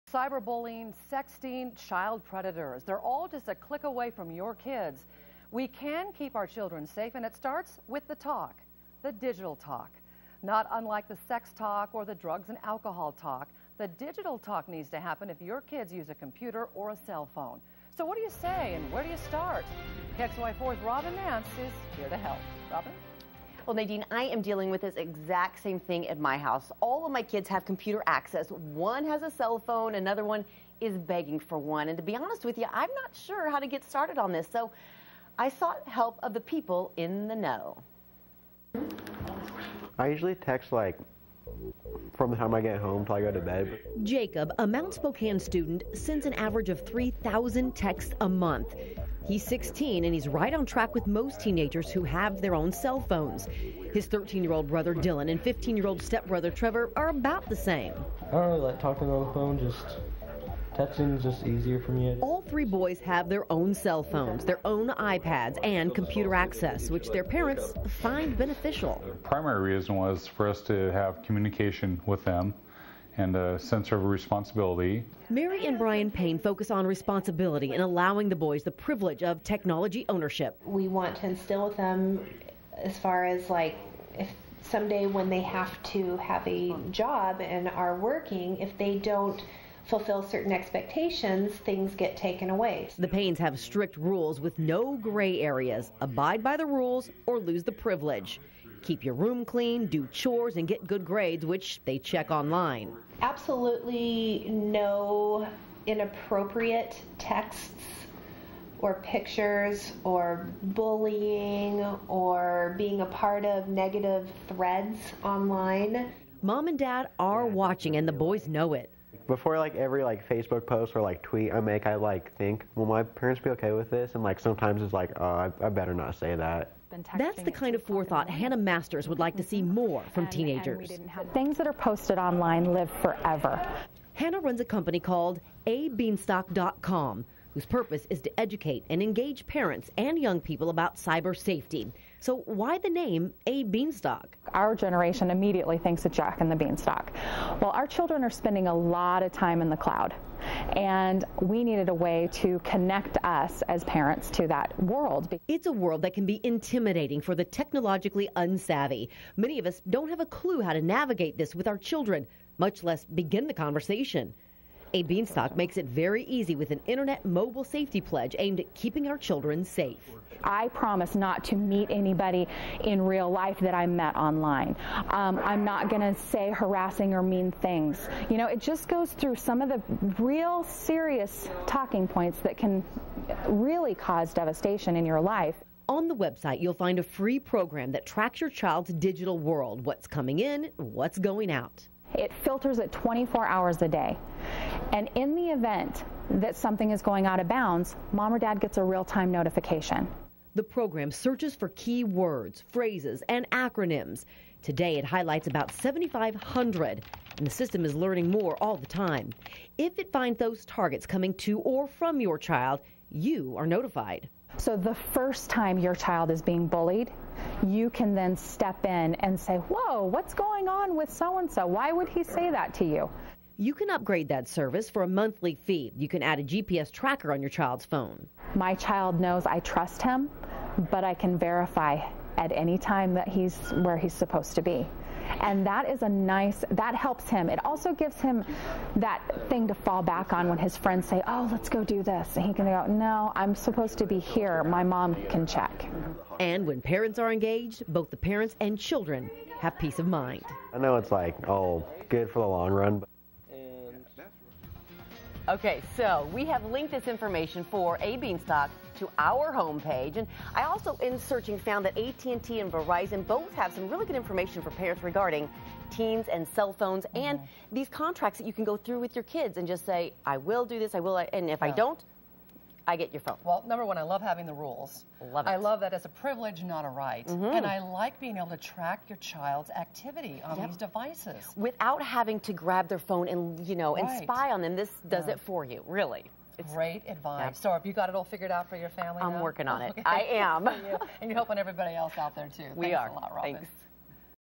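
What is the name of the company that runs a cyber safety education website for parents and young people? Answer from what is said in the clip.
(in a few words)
ABeanstalk.com.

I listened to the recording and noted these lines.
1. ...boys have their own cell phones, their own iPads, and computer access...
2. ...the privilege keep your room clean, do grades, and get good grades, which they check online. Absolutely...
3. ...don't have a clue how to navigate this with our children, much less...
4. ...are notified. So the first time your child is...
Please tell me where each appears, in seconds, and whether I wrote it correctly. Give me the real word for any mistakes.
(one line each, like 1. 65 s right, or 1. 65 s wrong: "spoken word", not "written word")
1. 62 s right
2. 97 s wrong: "chores", not "grades"
3. 159 s right
4. 213 s right.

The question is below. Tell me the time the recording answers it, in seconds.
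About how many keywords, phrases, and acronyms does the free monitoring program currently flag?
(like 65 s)
205 s.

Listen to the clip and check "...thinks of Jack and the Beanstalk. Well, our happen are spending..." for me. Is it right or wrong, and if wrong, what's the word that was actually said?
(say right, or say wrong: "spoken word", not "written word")
wrong: "children", not "happen".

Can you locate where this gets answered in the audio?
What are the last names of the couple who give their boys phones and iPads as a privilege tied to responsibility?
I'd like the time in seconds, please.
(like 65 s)
76 s.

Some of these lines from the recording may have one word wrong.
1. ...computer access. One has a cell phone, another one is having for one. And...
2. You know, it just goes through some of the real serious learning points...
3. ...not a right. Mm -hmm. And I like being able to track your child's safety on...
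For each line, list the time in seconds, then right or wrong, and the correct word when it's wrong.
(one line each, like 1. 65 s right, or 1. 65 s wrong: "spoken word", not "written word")
1. 27 s wrong: "begging", not "having"
2. 178 s wrong: "talking", not "learning"
3. 276 s wrong: "activity", not "safety".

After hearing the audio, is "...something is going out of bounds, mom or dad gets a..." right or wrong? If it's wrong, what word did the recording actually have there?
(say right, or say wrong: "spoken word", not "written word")
right.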